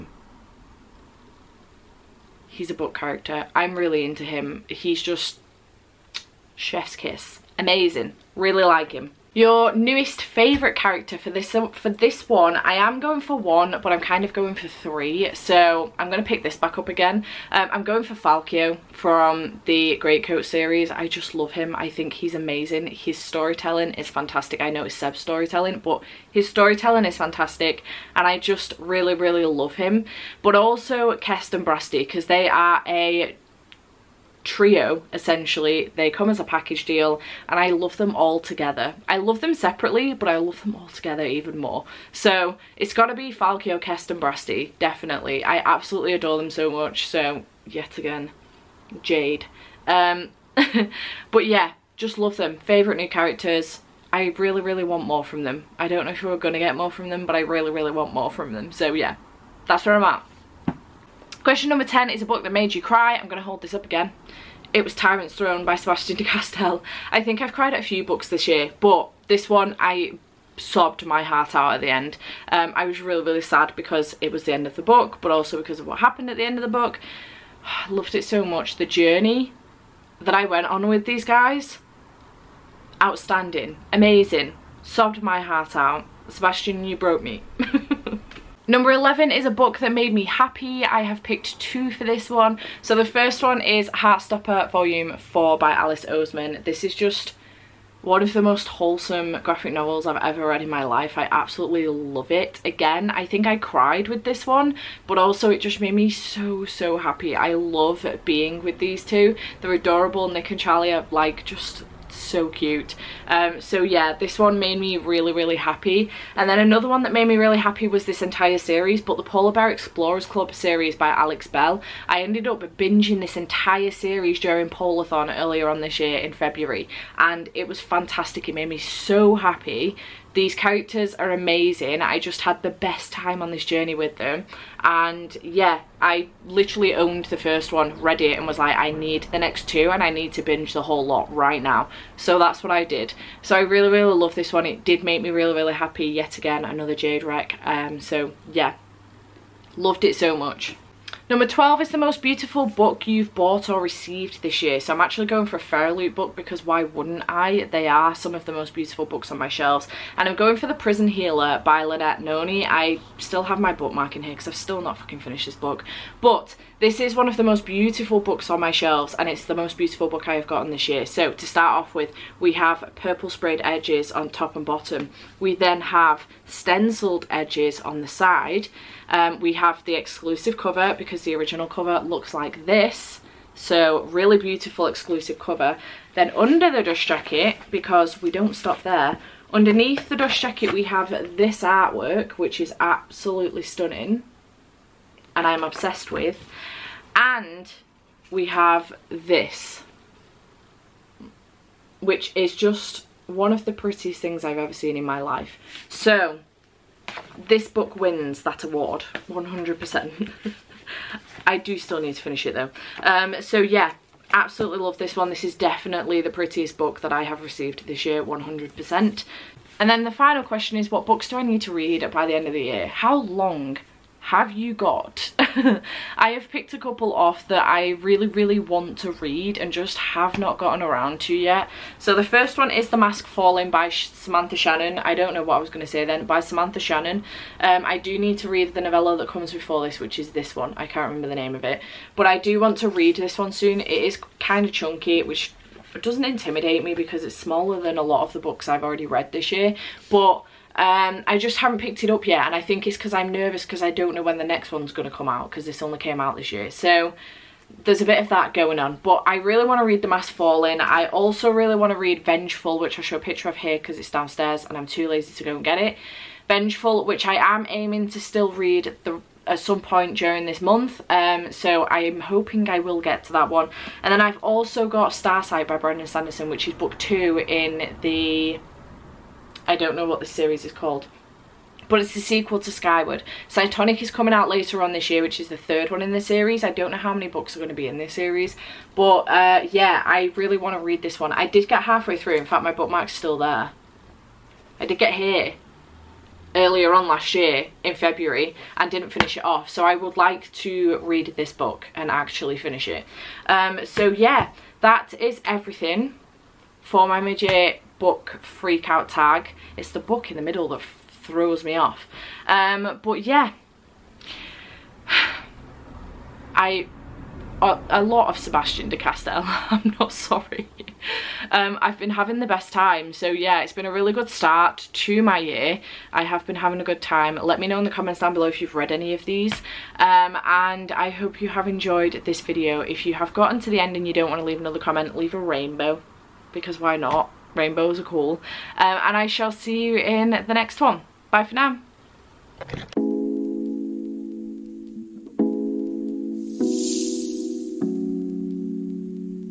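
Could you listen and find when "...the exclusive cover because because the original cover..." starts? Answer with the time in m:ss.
2:59.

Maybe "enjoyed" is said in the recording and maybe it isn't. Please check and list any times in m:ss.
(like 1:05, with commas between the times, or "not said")
5:31.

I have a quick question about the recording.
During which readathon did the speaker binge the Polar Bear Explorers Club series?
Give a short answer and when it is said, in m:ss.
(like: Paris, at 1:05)
Polathon, at 2:04.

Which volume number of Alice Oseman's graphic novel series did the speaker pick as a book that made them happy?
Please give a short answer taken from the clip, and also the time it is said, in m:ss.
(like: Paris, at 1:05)
4, at 1:34.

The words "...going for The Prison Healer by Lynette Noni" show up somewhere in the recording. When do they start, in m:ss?
2:40.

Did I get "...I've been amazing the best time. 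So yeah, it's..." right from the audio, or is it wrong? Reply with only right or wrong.
wrong.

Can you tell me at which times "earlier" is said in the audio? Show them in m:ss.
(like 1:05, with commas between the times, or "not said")
2:05, 4:56.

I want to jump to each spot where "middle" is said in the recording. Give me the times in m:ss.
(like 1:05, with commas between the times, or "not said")
5:10.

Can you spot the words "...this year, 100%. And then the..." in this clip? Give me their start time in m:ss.
3:37.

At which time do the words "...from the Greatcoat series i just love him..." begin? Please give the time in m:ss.
0:18.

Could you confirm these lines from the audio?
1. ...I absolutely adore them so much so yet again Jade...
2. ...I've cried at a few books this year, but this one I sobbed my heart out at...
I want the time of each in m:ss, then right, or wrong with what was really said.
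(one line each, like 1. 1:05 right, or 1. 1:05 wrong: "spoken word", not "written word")
1. 0:45 right
2. 1:07 right.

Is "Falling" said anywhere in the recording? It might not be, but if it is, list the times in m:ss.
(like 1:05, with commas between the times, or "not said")
3:53, 4:20.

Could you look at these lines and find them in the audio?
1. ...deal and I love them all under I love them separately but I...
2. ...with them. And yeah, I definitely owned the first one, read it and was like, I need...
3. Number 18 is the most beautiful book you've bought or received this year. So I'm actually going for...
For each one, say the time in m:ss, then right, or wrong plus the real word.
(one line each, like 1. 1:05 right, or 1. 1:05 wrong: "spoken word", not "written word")
1. 0:36 wrong: "together", not "under"
2. 2:13 wrong: "literally", not "definitely"
3. 2:31 wrong: "12", not "18".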